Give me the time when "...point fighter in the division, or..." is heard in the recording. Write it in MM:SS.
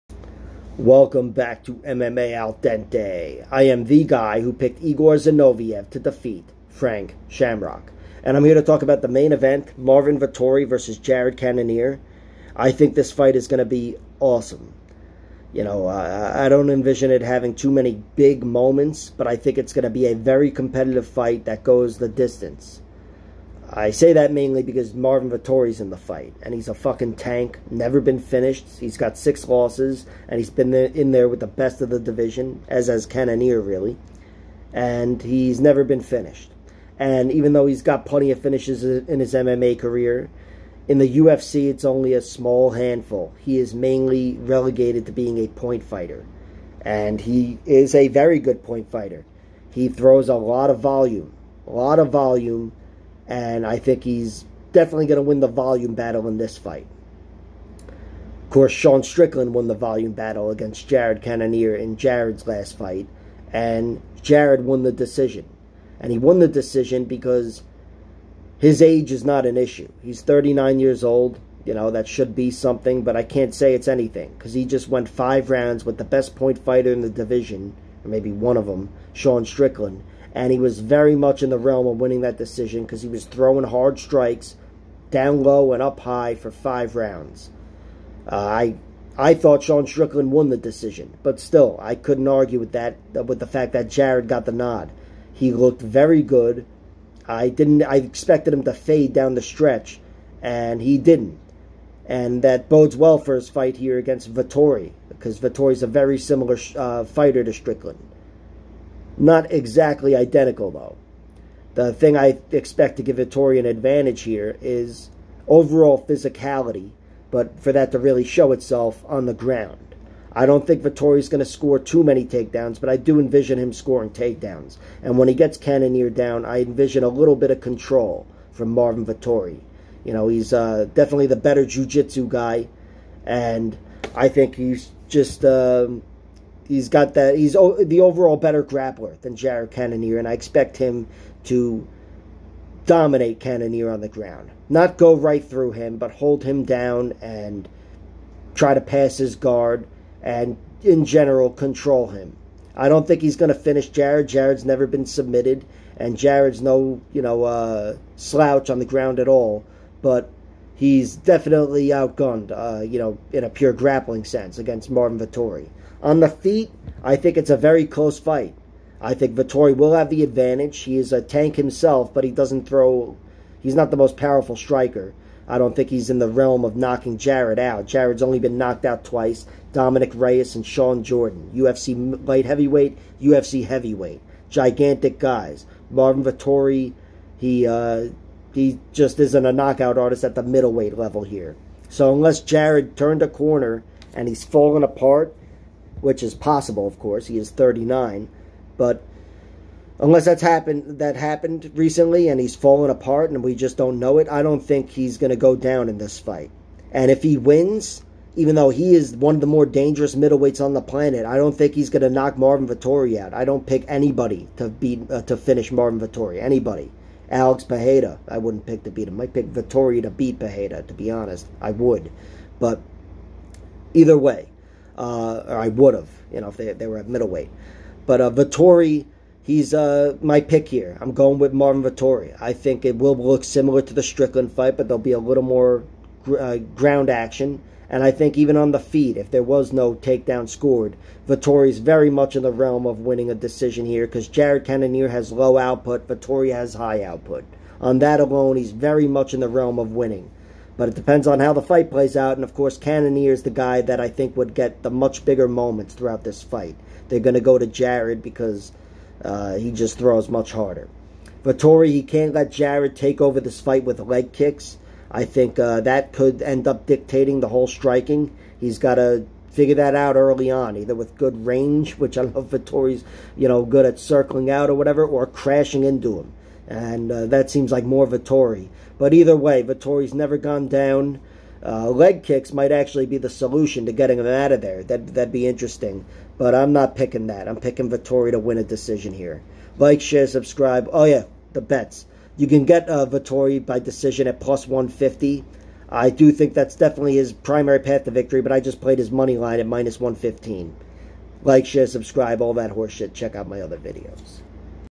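01:16.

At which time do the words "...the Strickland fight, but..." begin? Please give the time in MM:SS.
03:53.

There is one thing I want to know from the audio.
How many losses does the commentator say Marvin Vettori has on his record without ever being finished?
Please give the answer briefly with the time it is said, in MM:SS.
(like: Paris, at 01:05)
6, at 00:29.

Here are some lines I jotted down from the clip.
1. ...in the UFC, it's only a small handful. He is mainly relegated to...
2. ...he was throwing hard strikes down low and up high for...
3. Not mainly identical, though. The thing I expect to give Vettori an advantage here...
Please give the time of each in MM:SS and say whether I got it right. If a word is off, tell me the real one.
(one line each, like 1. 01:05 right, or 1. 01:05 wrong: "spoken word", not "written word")
1. 00:40 right
2. 01:23 right
3. 01:49 wrong: "exactly", not "mainly".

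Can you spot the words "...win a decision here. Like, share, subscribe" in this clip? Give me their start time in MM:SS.
04:48.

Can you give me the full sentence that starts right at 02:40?
But he's definitely outgunned, uh, you know, in a pure grappling sense against Marvin Vettori.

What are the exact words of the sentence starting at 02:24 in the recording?
Not go right through him, but hold him down and try to pass his guard and in general control him.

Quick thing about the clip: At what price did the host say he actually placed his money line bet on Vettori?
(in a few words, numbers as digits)
-115.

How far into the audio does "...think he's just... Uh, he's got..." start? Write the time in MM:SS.
02:14.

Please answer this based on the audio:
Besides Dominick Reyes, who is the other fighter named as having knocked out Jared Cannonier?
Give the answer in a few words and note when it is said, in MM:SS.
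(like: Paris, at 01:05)
Shawn Jordan, at 03:00.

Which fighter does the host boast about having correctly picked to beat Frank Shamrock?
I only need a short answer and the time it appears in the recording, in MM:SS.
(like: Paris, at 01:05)
Igor Zinoviev, at 00:04.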